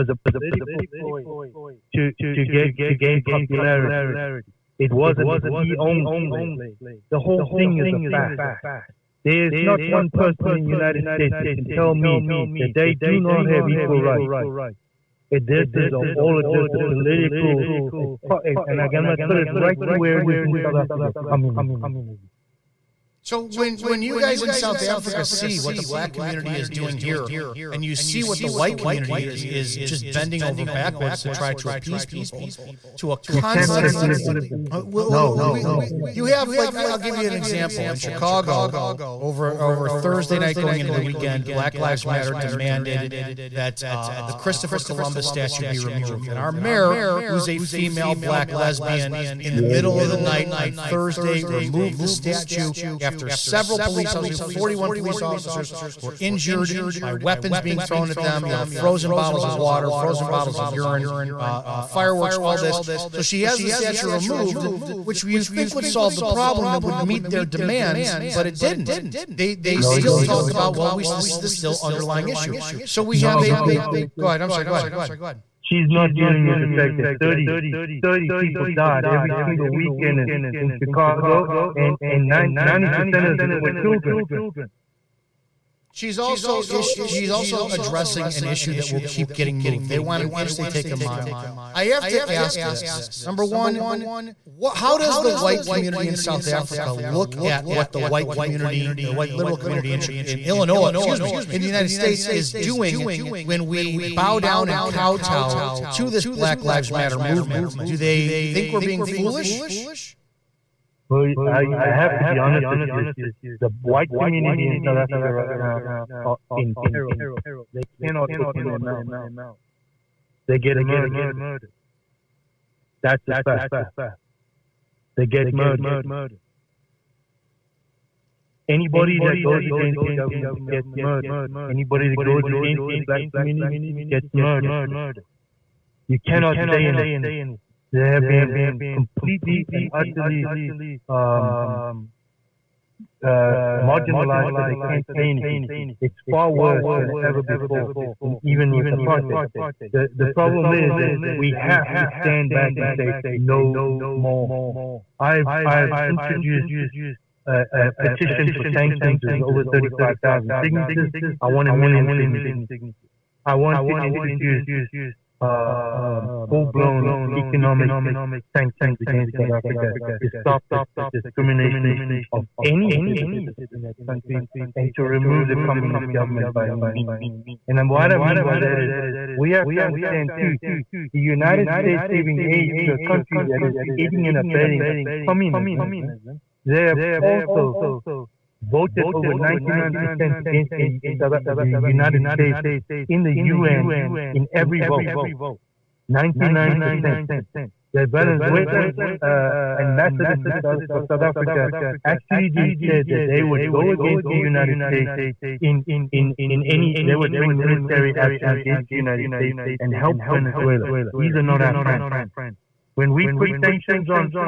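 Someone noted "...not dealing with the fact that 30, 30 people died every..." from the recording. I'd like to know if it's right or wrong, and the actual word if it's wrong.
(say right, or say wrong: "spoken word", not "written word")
right.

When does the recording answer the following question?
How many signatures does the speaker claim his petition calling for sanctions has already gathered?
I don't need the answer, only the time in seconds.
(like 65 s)
159 s.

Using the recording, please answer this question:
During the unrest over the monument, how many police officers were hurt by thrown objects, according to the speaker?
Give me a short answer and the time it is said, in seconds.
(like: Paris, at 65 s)
41, at 54 s.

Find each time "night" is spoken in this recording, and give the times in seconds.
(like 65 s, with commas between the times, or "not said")
40 s, 50 s.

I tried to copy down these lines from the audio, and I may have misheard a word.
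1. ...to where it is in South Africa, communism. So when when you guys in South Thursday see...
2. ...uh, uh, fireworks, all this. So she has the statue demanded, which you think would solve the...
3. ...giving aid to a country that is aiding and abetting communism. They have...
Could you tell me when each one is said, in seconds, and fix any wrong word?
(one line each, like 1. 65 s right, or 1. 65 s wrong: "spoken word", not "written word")
1. 19 s wrong: "Africa", not "Thursday"
2. 61 s wrong: "removed", not "demanded"
3. 182 s right.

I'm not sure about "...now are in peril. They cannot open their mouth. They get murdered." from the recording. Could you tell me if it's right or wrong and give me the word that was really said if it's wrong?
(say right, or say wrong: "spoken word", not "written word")
right.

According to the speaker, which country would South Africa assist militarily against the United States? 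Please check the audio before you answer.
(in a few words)
Venezuela.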